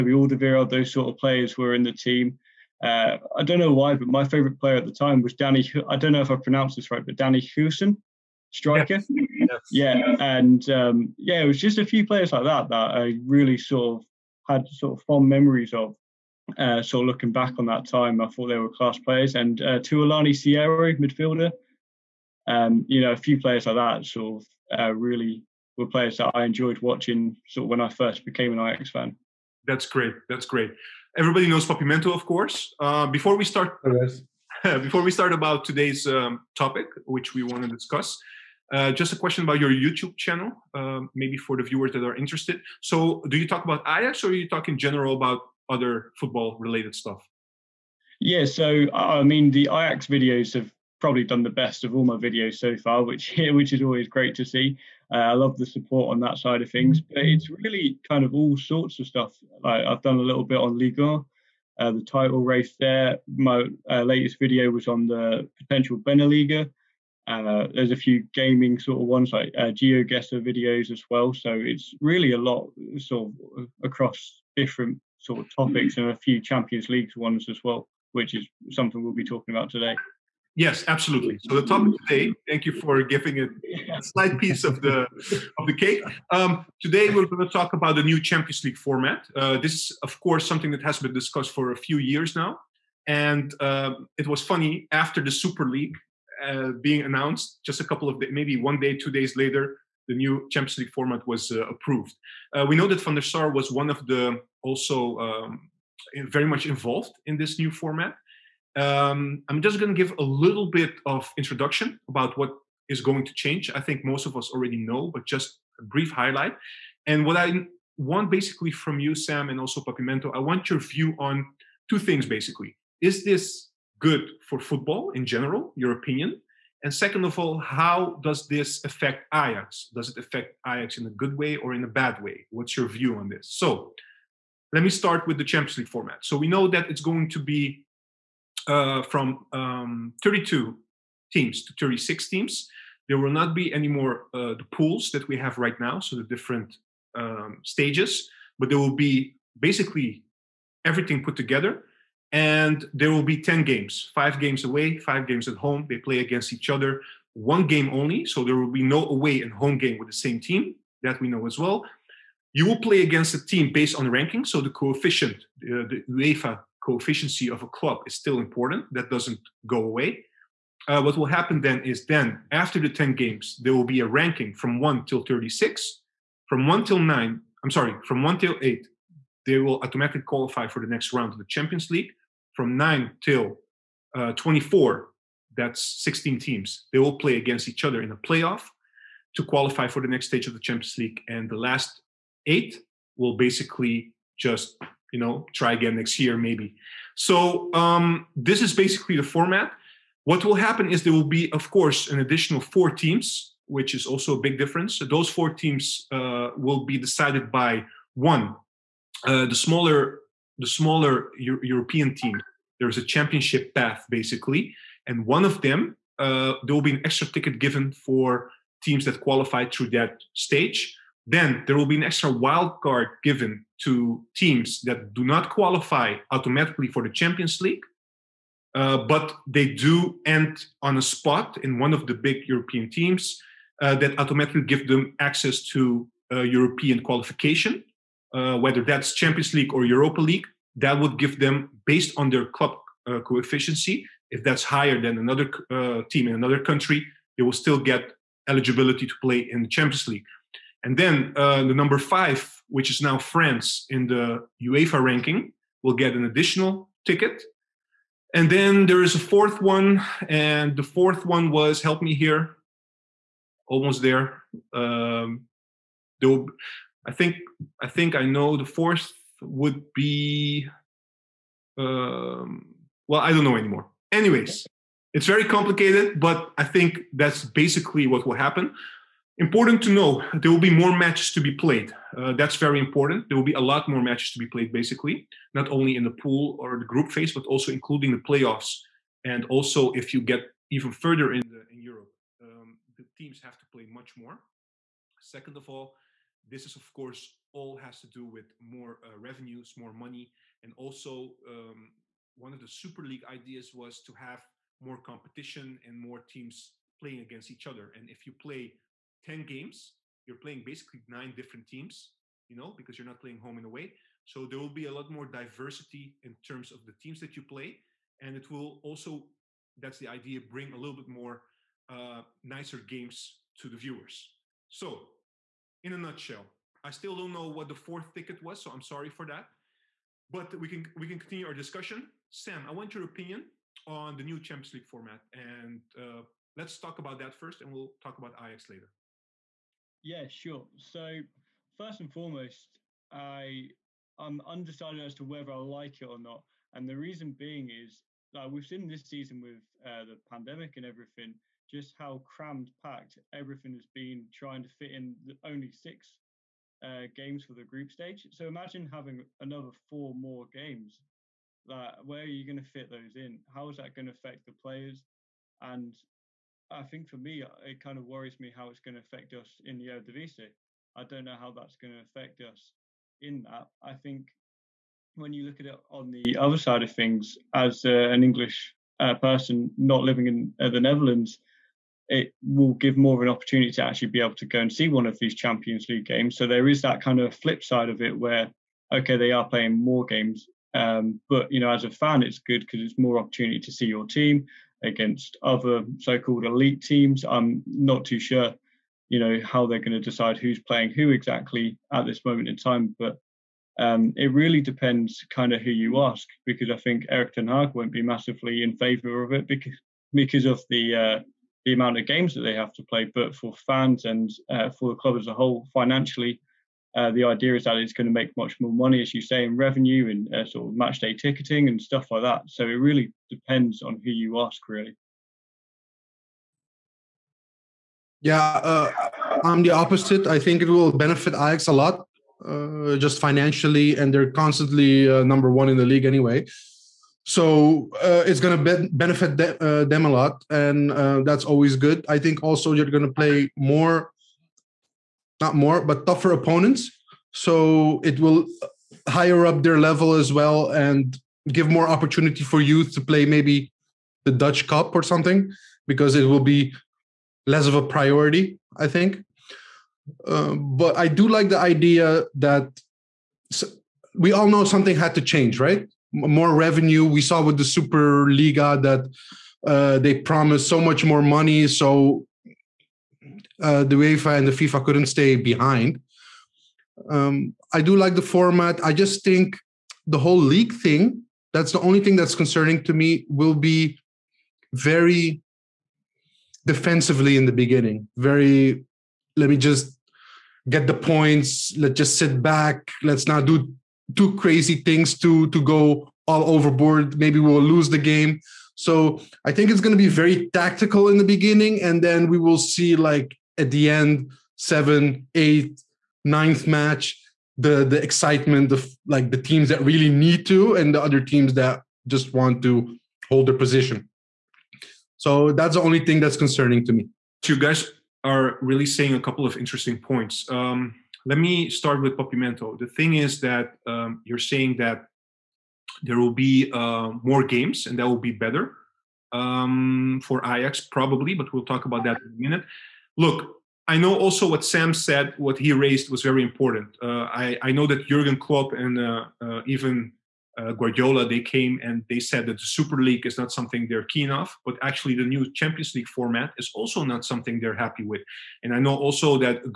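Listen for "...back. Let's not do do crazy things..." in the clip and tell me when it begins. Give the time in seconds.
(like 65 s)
492 s.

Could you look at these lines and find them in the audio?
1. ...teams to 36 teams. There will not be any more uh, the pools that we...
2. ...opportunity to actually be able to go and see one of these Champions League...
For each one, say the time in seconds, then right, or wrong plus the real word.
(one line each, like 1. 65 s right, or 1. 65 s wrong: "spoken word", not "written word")
1. 141 s right
2. 383 s right.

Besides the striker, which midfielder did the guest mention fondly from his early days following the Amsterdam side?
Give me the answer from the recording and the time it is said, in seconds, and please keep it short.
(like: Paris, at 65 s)
Thulani Serero, at 19 s.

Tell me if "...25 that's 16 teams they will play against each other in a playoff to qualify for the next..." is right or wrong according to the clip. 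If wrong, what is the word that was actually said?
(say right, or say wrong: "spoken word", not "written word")
wrong: "24", not "25".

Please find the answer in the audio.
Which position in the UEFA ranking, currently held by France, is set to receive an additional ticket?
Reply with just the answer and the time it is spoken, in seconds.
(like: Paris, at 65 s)
Number five, at 251 s.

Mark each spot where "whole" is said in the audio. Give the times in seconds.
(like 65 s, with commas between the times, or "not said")
415 s, 480 s.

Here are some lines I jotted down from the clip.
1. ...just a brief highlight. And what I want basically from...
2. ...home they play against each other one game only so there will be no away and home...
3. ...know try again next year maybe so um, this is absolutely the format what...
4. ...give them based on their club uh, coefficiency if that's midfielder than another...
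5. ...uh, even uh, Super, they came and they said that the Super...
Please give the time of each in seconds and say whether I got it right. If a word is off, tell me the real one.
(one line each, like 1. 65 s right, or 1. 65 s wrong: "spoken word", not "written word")
1. 115 s right
2. 155 s right
3. 195 s wrong: "basically", not "absolutely"
4. 241 s wrong: "higher", not "midfielder"
5. 539 s wrong: "Guardiola", not "Super".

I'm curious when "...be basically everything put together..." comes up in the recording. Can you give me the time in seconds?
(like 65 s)
148 s.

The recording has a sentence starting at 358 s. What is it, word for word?
So imagine having another four more games.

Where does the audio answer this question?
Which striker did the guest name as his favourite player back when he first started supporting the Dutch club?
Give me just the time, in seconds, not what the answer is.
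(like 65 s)
7 s.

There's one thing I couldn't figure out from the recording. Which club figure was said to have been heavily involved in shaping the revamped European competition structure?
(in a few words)
Van der Sar.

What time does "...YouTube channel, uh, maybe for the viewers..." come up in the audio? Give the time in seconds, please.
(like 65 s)
39 s.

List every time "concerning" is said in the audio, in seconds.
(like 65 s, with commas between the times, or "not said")
482 s, 516 s.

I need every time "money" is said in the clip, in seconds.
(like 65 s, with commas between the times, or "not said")
299 s, 418 s, 471 s.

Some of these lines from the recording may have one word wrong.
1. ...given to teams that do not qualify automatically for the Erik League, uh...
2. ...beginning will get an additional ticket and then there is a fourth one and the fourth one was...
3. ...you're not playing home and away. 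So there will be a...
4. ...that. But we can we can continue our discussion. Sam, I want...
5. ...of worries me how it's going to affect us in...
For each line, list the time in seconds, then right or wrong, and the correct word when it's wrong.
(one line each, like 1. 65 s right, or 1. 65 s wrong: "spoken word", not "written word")
1. 223 s wrong: "Champions", not "Erik"
2. 255 s wrong: "ranking", not "beginning"
3. 312 s right
4. 329 s right
5. 367 s right.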